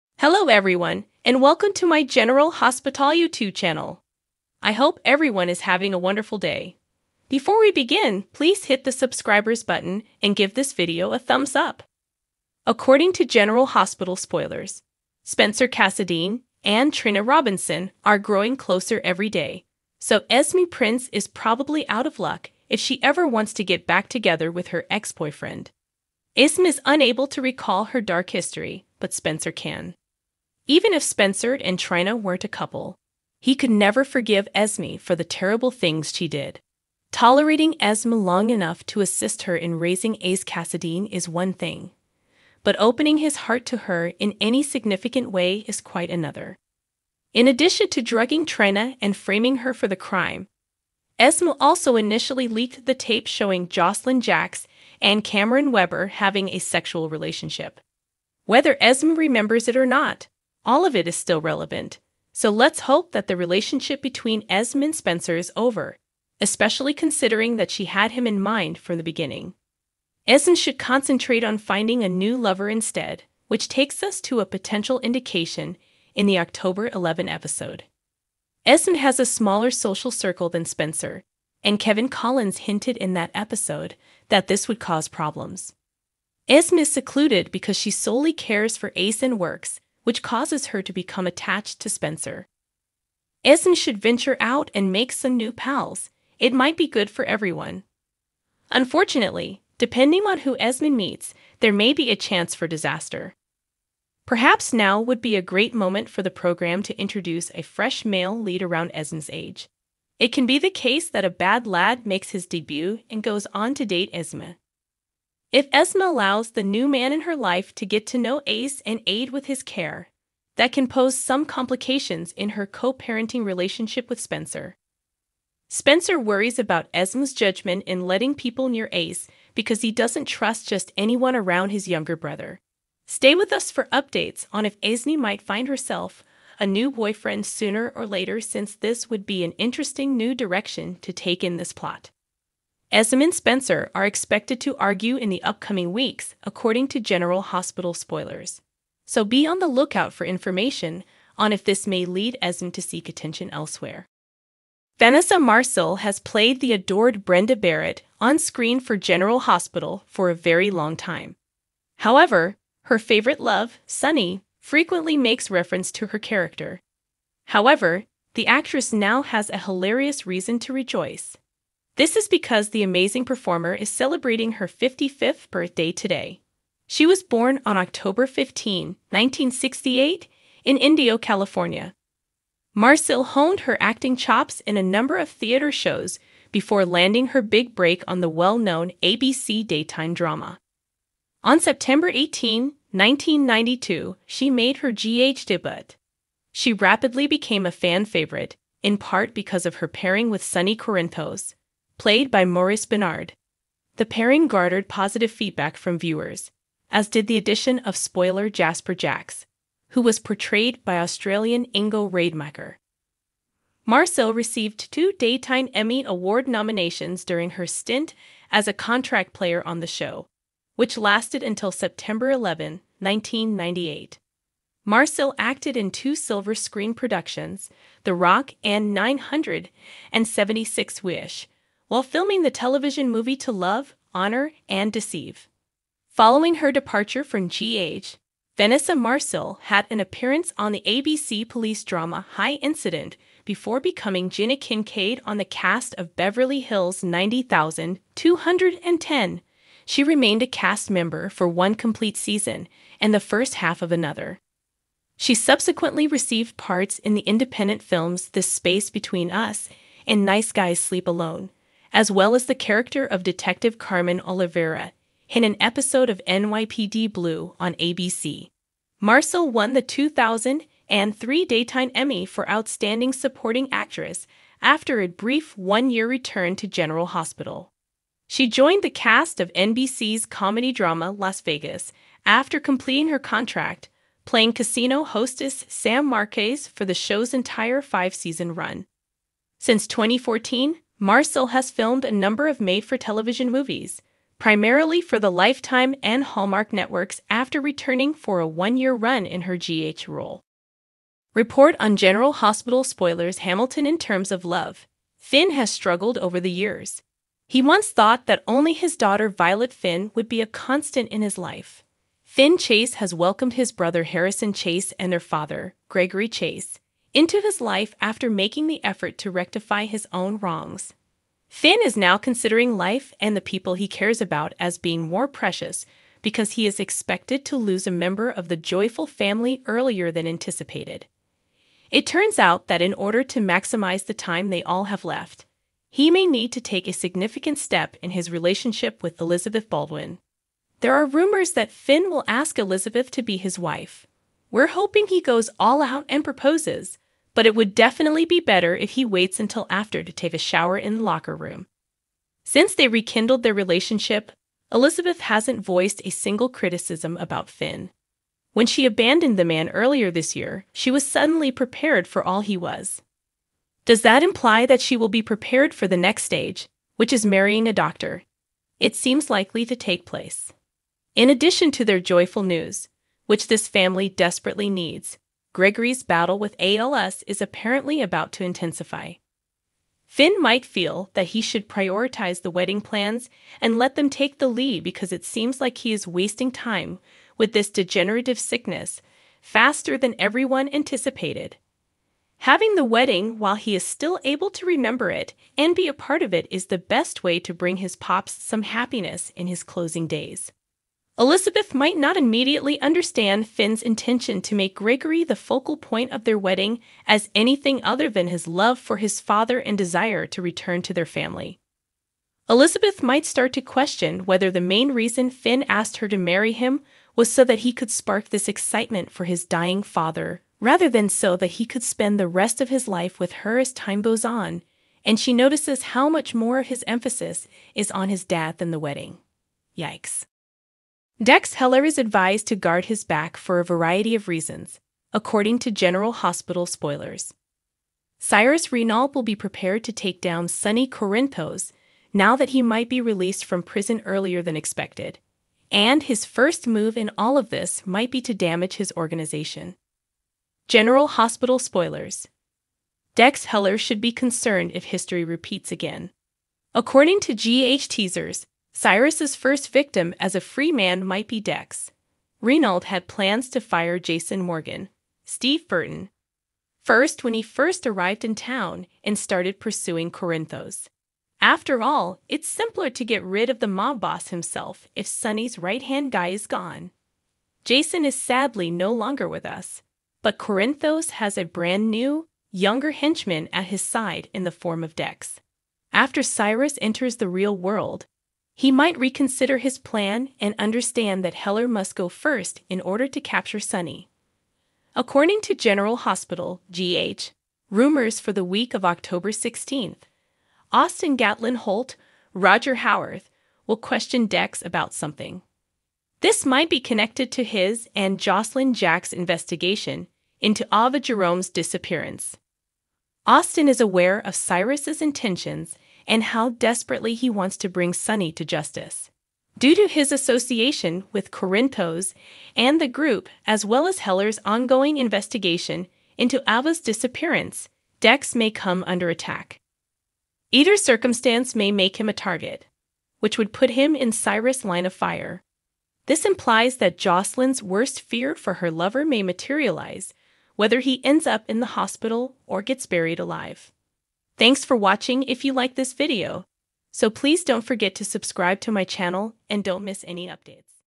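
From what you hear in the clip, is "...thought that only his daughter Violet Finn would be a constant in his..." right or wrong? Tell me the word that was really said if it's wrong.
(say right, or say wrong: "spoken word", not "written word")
right.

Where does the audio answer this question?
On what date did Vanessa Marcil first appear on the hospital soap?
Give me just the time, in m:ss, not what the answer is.
3:11.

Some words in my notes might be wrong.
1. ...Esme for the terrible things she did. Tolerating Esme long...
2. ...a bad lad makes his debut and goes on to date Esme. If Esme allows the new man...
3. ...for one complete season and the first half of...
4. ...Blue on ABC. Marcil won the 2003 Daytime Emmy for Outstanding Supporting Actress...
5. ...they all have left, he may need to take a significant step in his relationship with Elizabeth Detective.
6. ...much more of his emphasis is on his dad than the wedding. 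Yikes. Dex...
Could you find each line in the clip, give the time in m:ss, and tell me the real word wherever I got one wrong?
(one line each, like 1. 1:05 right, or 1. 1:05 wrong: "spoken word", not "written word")
1. 0:34 right
2. 1:51 right
3. 4:11 right
4. 4:27 right
5. 5:34 wrong: "Baldwin", not "Detective"
6. 7:06 right.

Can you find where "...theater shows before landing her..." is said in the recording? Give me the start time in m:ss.
3:05.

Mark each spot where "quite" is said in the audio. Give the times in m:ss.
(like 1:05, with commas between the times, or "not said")
0:45.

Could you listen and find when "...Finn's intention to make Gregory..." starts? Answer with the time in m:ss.
6:43.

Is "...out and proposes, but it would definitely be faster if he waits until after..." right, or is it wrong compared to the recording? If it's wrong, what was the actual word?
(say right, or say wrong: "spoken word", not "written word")
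wrong: "better", not "faster".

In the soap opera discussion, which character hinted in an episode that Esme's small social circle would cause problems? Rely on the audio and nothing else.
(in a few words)
Kevin Collins.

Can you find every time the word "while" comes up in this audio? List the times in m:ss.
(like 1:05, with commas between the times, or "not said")
3:51, 6:33.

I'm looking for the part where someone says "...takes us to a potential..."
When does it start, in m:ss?
1:13.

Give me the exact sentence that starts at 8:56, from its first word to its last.
This implies that Josslyn's worst fear for her lover may materialize, whether he ends up in the hospital or gets buried alive.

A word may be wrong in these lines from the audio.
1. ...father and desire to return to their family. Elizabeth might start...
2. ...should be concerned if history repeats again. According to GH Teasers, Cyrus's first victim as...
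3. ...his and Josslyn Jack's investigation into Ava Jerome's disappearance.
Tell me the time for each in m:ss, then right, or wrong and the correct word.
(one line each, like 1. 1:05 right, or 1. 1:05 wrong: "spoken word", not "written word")
1. 6:49 right
2. 7:33 right
3. 8:27 right.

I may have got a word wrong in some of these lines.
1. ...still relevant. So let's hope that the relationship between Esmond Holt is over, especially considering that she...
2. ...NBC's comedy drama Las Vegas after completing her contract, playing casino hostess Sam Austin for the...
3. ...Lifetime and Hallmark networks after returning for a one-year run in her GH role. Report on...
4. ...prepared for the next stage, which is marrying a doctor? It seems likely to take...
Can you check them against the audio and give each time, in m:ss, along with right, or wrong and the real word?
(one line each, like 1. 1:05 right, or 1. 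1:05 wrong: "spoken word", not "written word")
1. 1:01 wrong: "Spencer", not "Holt"
2. 4:39 wrong: "Marquez", not "Austin"
3. 4:55 right
4. 6:05 right.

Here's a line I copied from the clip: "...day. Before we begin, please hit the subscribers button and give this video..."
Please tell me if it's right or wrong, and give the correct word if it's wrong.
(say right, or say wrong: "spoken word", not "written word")
right.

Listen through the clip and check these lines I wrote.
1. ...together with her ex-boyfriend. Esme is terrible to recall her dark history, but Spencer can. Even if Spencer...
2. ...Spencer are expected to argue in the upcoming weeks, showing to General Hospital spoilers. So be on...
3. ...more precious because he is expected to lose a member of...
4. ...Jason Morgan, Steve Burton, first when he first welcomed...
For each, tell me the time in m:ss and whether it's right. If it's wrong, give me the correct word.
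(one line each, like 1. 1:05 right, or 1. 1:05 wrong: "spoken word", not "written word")
1. 0:24 wrong: "unable", not "terrible"
2. 2:23 wrong: "according", not "showing"
3. 5:25 right
4. 7:43 wrong: "arrived", not "welcomed".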